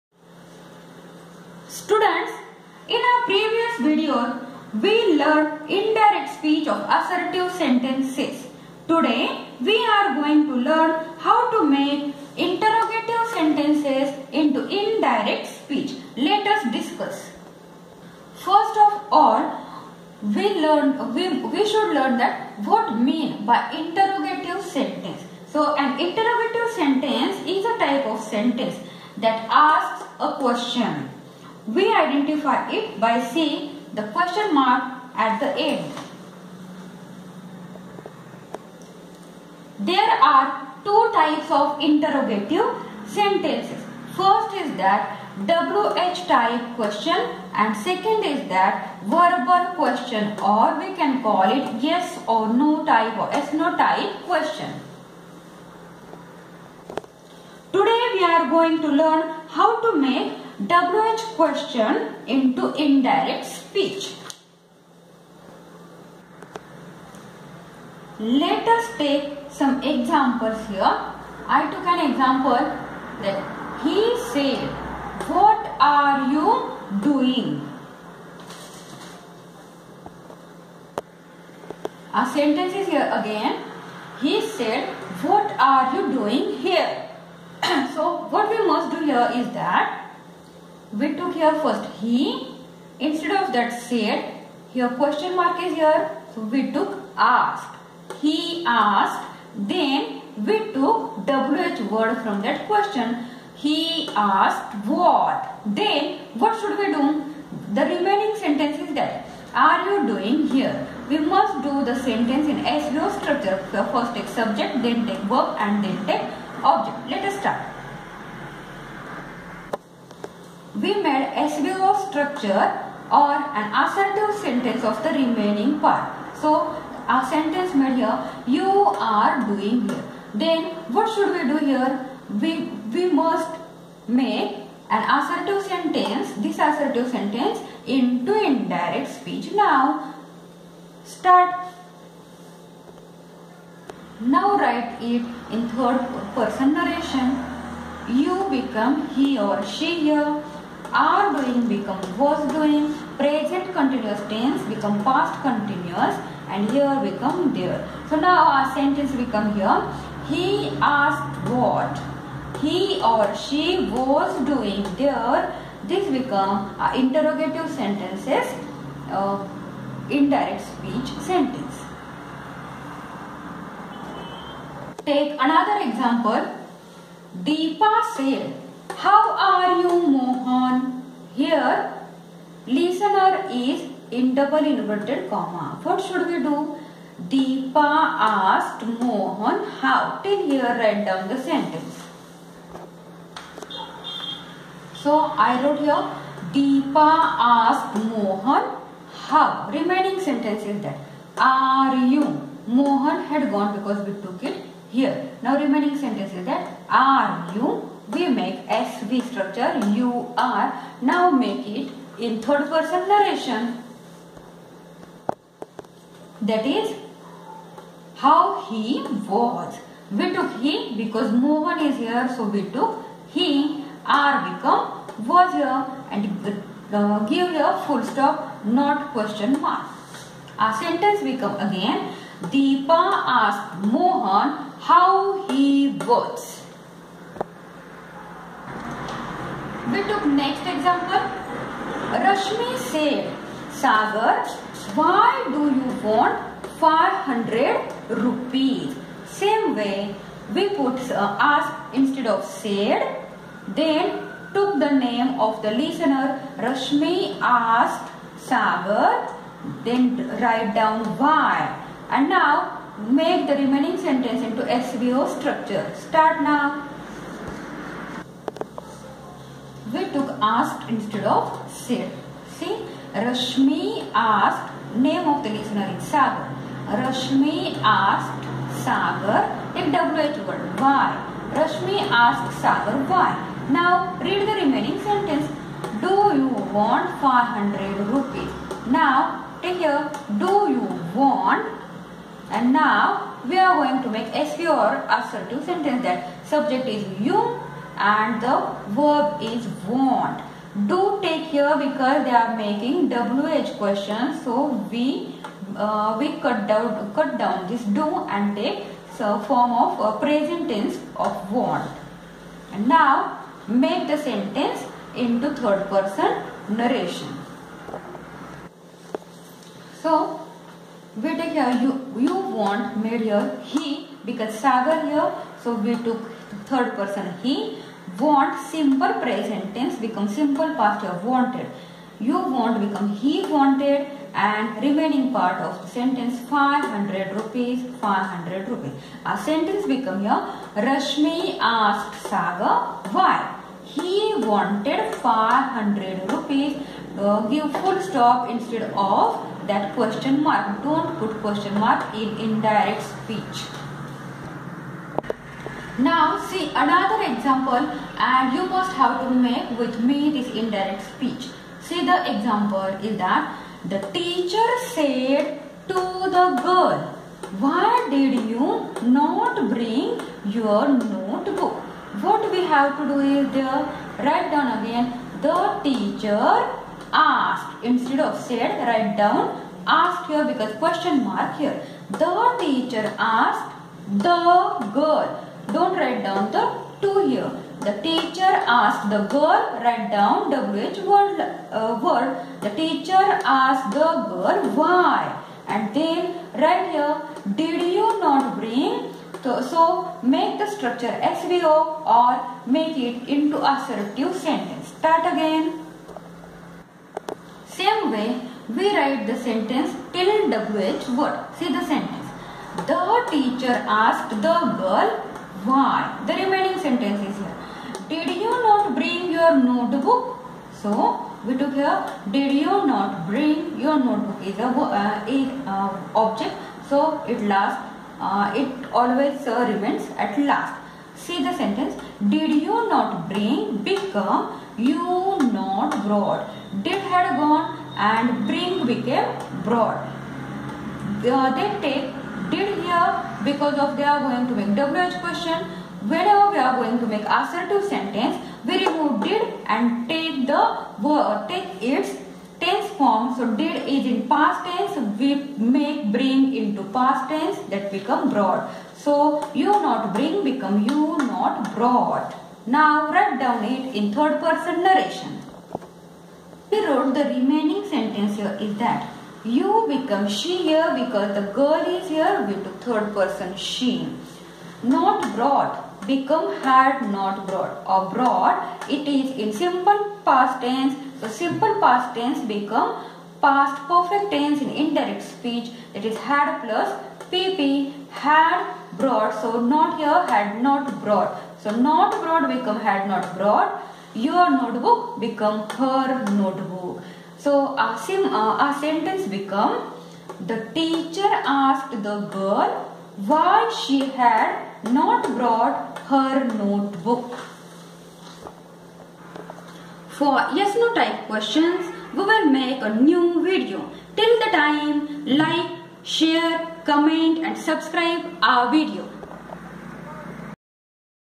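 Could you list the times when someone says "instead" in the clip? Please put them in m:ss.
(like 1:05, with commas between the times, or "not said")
1:32, 4:11, 4:30, 5:48, 6:17.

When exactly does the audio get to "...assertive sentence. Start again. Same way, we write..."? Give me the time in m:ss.
6:43.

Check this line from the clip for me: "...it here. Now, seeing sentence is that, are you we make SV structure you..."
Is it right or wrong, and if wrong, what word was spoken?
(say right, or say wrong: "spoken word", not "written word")
wrong: "remaining", not "seeing".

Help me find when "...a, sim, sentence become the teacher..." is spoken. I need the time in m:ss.
8:17.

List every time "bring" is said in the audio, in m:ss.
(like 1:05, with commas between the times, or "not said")
6:09, 6:38, 6:58, 7:03, 7:13, 7:18, 7:36, 7:40.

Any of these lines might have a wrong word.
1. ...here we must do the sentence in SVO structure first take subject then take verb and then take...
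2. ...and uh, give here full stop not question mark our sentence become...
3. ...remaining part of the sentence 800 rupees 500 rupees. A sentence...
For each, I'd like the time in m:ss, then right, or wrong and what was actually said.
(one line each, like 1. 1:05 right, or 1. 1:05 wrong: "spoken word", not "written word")
1. 1:50 right
2. 3:46 right
3. 5:34 wrong: "500", not "800".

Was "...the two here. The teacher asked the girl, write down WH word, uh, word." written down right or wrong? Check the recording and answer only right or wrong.
right.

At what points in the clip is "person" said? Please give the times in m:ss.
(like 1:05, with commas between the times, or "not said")
2:26, 3:32, 5:15, 5:26, 7:44, 7:53.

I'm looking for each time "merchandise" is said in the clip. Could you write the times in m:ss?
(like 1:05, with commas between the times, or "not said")
not said.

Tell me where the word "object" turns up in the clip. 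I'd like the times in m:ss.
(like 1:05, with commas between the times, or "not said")
1:56, 7:06.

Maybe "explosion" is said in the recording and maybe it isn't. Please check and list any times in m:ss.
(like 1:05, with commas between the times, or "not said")
not said.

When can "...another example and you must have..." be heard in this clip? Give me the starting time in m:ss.
5:56.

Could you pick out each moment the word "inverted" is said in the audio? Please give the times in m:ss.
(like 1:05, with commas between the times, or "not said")
3:04.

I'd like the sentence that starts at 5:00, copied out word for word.
Do take here because they are making WH questions.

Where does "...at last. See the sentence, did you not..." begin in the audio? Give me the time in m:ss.
7:10.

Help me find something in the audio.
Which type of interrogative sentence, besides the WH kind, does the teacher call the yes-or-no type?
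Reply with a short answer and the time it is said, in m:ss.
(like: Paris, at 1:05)
Verbal question, at 0:49.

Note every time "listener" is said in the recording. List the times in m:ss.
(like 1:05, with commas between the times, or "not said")
3:02, 4:15, 4:35.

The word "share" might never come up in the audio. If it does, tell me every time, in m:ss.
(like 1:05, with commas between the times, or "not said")
8:36.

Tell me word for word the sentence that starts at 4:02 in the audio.
Rashmi said, Sagar, why do you want 500 rupees?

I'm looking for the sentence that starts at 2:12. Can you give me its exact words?
We, we must make an assertive sentence, this assertive sentence into indirect speech.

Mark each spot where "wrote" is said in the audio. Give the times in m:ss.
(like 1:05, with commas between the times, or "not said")
3:15, 7:46.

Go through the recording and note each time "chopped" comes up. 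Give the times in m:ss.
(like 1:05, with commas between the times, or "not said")
not said.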